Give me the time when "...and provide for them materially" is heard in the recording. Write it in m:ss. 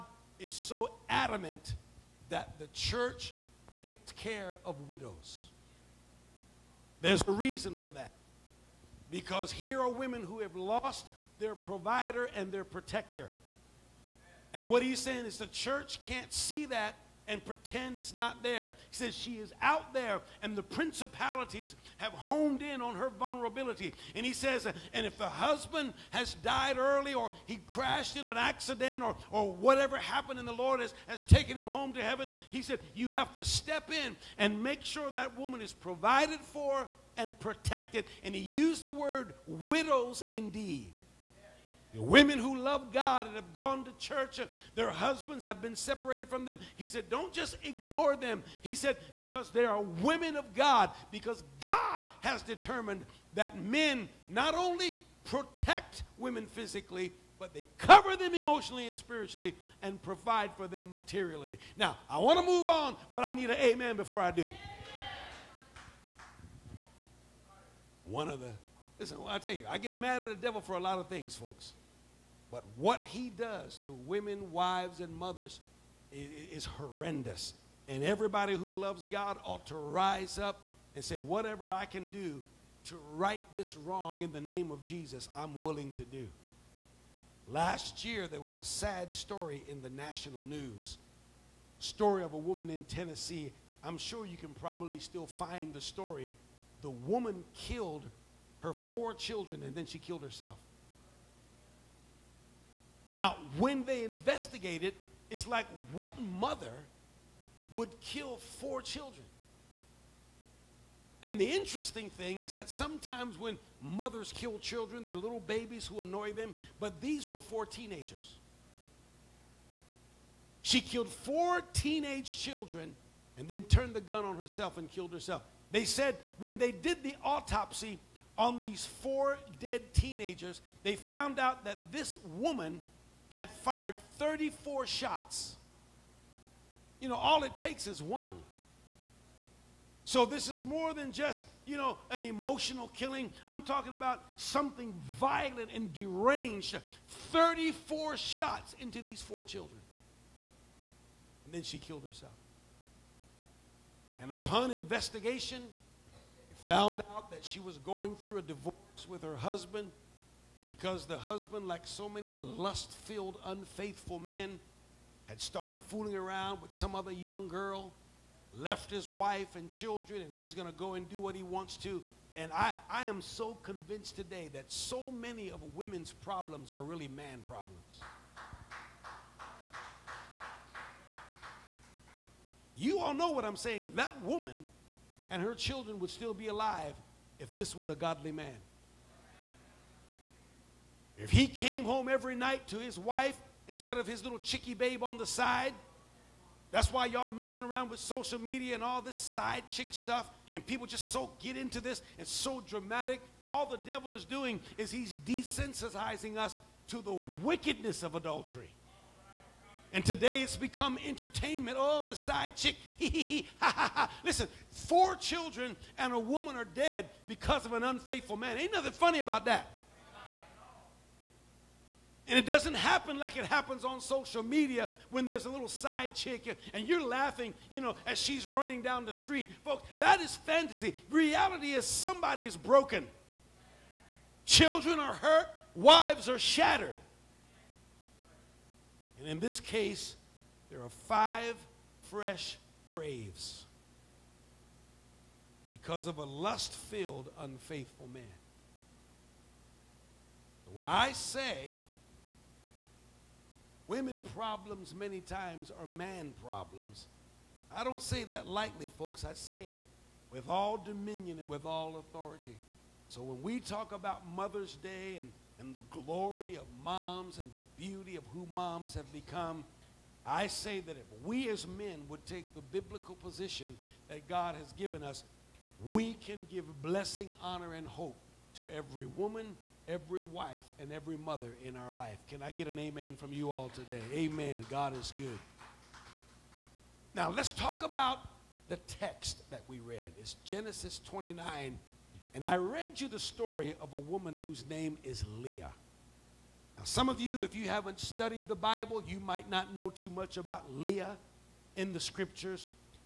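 0:59.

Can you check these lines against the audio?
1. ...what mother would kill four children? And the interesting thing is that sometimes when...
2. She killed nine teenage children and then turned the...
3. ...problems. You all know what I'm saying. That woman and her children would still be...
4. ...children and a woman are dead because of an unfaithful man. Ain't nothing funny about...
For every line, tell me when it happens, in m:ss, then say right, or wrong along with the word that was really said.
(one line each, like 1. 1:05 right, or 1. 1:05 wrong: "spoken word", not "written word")
1. 1:45 right
2. 2:00 wrong: "four", not "nine"
3. 2:57 right
4. 3:35 right.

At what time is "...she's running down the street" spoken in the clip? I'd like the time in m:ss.
3:48.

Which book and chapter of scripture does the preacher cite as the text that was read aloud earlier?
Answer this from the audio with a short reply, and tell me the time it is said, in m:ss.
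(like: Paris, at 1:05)
Genesis 29, at 4:50.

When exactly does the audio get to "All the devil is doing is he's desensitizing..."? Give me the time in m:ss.
3:23.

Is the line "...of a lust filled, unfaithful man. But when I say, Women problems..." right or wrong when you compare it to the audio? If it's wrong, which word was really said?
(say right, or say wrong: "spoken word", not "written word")
right.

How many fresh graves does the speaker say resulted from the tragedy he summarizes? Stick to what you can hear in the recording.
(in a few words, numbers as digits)
5.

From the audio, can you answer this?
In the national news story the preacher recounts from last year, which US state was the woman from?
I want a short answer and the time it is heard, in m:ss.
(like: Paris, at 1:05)
Tennessee, at 1:32.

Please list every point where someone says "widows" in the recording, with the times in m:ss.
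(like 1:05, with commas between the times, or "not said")
0:04, 0:39.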